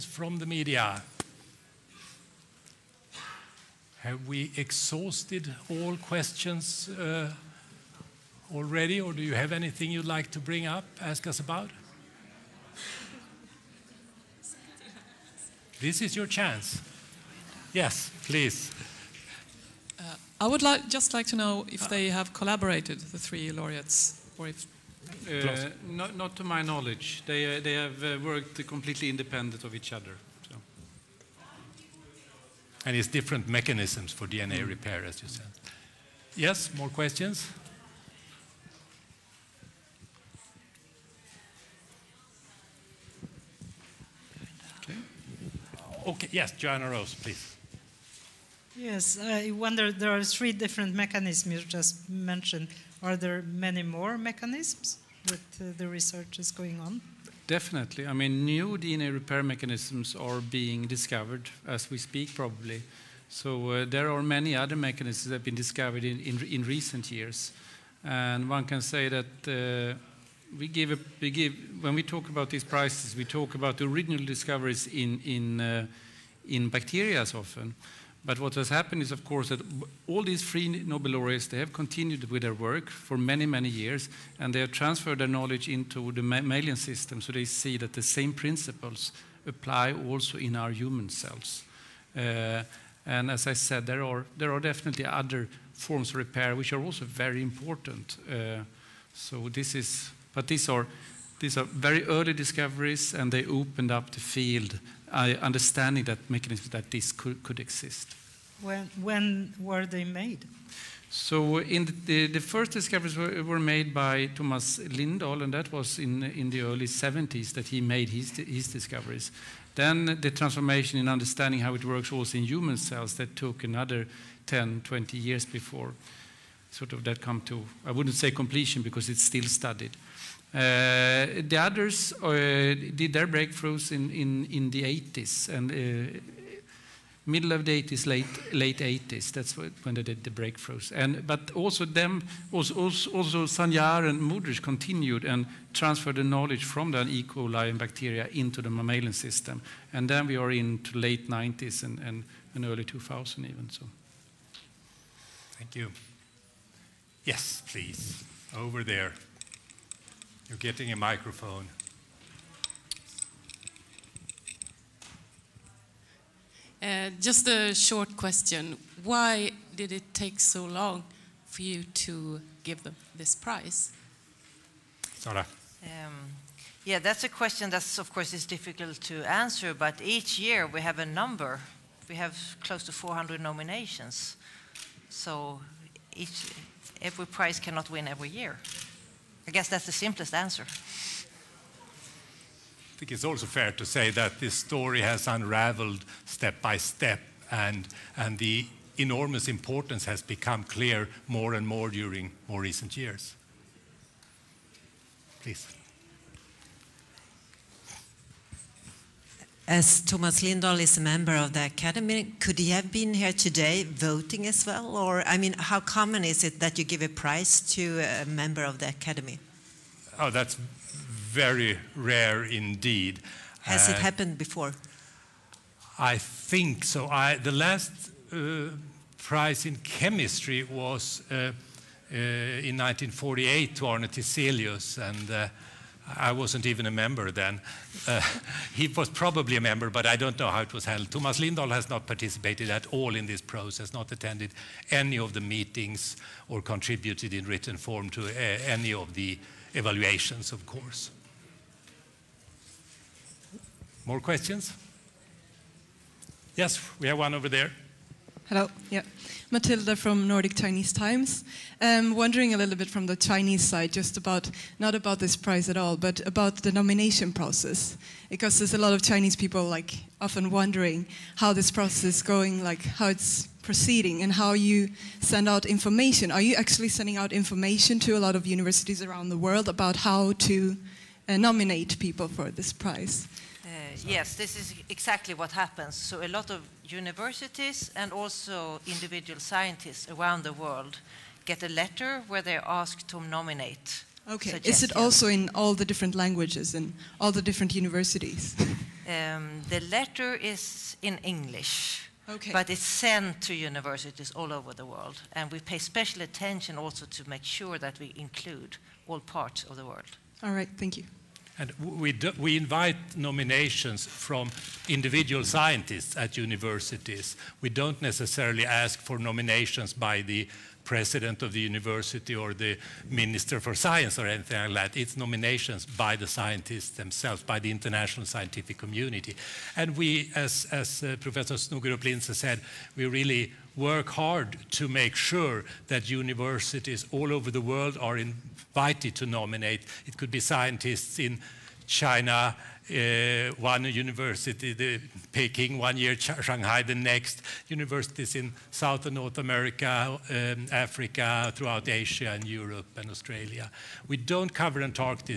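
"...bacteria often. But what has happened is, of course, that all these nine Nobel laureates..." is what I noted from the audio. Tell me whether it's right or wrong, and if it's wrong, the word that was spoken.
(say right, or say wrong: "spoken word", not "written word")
wrong: "three", not "nine".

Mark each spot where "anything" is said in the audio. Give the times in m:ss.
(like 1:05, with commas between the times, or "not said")
0:09, 5:24.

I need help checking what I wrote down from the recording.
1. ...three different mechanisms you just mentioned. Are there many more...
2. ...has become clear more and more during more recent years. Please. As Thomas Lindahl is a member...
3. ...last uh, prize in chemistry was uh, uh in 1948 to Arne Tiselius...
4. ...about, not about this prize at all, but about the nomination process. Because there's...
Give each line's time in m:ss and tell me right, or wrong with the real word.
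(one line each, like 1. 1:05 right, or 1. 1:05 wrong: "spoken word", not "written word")
1. 0:50 right
2. 3:20 right
3. 3:47 right
4. 4:24 right.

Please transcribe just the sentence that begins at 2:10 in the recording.
Eh, the others eh, did their breakthroughs in, in, in the 80s and eh, middle of the 80s, late late 80s.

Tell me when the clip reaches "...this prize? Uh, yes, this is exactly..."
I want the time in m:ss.
4:42.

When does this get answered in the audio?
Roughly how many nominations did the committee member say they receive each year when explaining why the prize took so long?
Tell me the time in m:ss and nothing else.
3:02.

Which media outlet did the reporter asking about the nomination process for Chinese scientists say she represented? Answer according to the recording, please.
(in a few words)
Nordic Chinese Times.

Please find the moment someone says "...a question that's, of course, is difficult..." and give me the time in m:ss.
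2:57.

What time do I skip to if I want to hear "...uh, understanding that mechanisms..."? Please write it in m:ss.
1:45.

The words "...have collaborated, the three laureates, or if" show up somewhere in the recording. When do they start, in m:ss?
0:22.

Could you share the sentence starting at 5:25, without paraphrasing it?
It's nominations by the scientists themselves, by the international scientific community.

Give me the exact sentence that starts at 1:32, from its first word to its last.
Uh, and as I said, there are there are definitely other forms of repair which are also very important.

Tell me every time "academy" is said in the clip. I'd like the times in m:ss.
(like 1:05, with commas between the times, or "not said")
3:31, 3:38.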